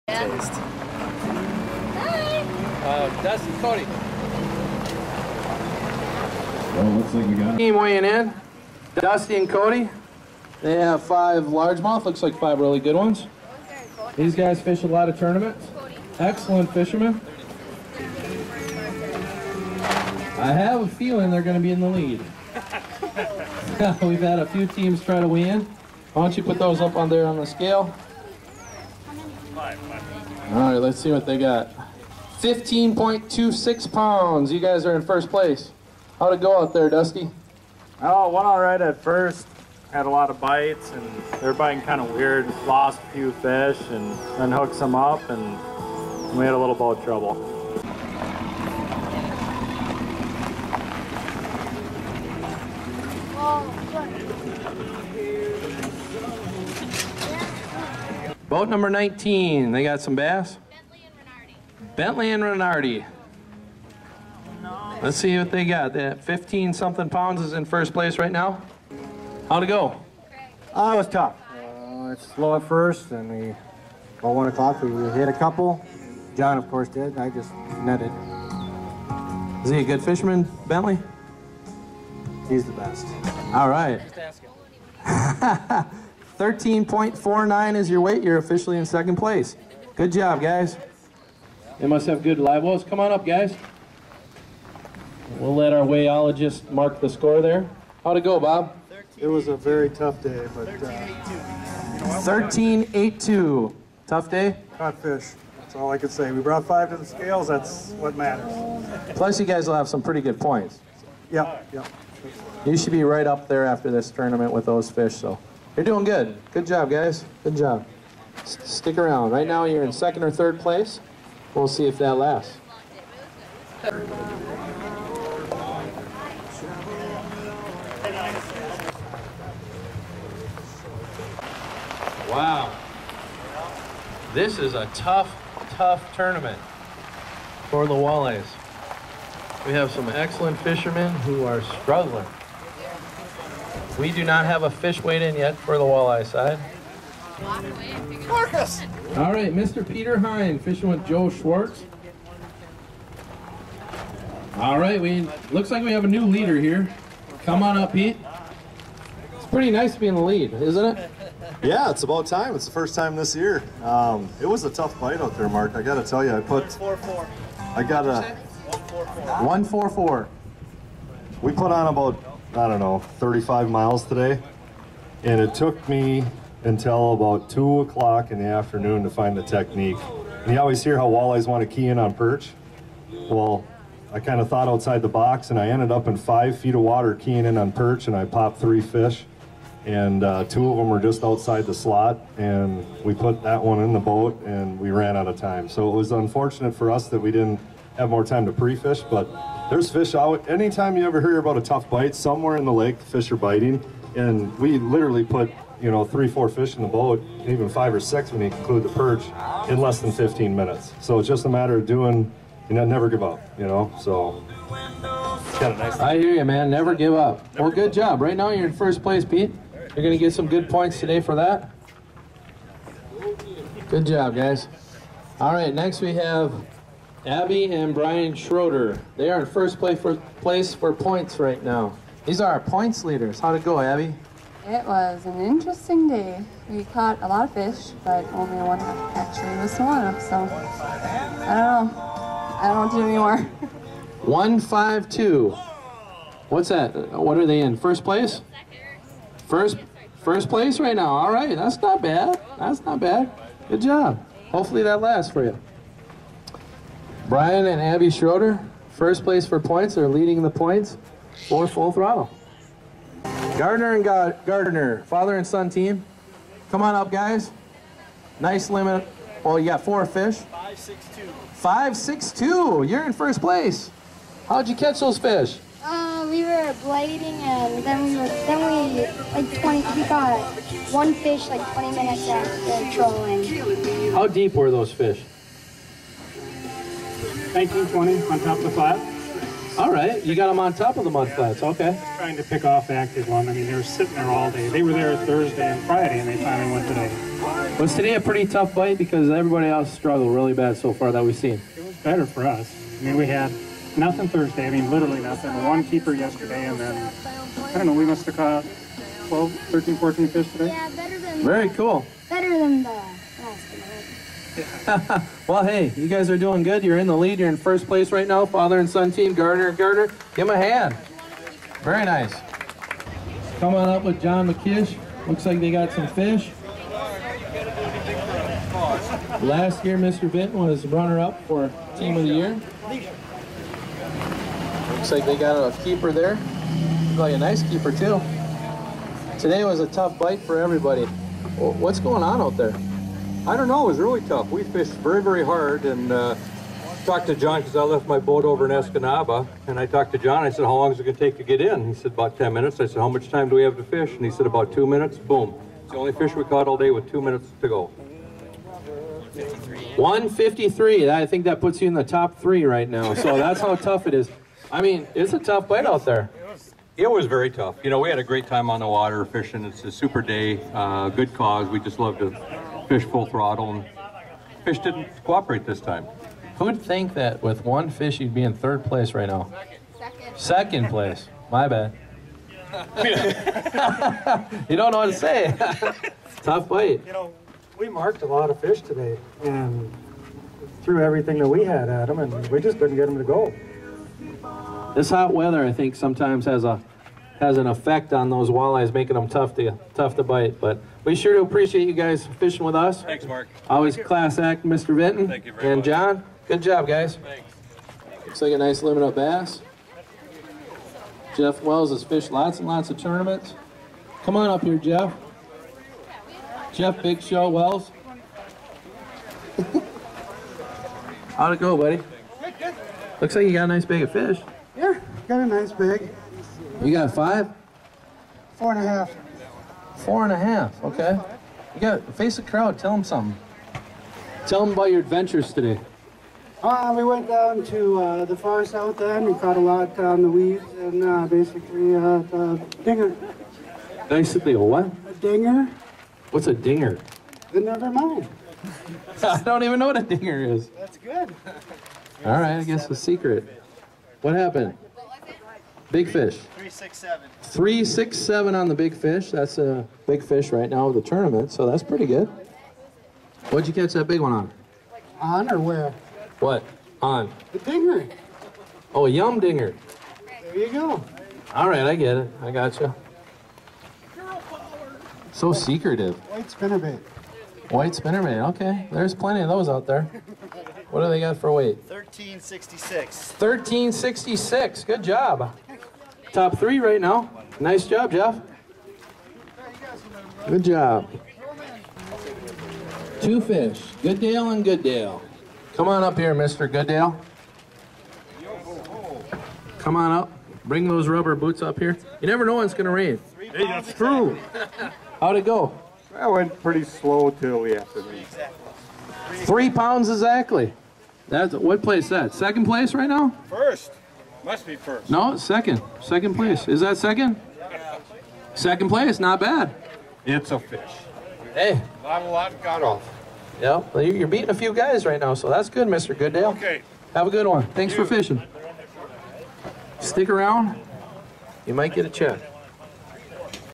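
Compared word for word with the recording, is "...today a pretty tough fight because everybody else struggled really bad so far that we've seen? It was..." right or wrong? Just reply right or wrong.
right.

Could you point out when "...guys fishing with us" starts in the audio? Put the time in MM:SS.
06:41.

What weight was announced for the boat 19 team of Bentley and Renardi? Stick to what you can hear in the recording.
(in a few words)
13.49.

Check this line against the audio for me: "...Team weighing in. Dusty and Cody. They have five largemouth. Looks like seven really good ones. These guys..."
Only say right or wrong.
wrong.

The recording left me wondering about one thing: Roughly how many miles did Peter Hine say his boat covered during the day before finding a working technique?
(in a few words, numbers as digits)
35 miles.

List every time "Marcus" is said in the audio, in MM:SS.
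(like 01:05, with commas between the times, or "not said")
02:28.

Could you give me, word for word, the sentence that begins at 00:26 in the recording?
Why don't you put those up on there on the scale?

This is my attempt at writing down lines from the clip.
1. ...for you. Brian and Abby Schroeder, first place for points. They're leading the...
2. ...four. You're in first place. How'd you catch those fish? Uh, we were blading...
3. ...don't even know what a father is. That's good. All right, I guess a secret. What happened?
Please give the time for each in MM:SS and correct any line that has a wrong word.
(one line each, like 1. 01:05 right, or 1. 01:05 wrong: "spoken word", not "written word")
1. 04:15 right
2. 04:32 wrong: "two", not "four"
3. 07:29 wrong: "dinger", not "father".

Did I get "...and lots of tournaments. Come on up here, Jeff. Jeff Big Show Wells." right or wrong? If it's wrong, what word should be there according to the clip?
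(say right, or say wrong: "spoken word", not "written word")
right.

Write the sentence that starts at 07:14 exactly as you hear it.
Tell them about your adventures today.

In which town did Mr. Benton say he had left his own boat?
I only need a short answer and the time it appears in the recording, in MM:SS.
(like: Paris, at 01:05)
Escanaba, at 05:48.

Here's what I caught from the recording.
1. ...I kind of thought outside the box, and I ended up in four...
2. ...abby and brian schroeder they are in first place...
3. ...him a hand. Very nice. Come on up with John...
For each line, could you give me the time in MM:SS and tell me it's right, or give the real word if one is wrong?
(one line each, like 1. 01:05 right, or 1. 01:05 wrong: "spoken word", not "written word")
1. 03:04 wrong: "five", not "four"
2. 03:47 right
3. 05:20 right.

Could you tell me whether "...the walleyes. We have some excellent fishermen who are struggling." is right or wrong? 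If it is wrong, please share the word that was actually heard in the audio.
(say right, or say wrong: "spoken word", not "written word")
right.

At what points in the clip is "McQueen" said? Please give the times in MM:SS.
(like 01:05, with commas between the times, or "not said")
not said.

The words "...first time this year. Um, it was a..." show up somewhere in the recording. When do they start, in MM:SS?
02:42.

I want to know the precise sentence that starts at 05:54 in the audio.
And he said, about two minutes.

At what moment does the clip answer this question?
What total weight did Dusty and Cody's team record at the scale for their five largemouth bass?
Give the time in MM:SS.
00:32.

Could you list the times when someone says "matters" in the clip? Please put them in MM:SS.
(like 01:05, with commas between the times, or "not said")
01:48, 03:31.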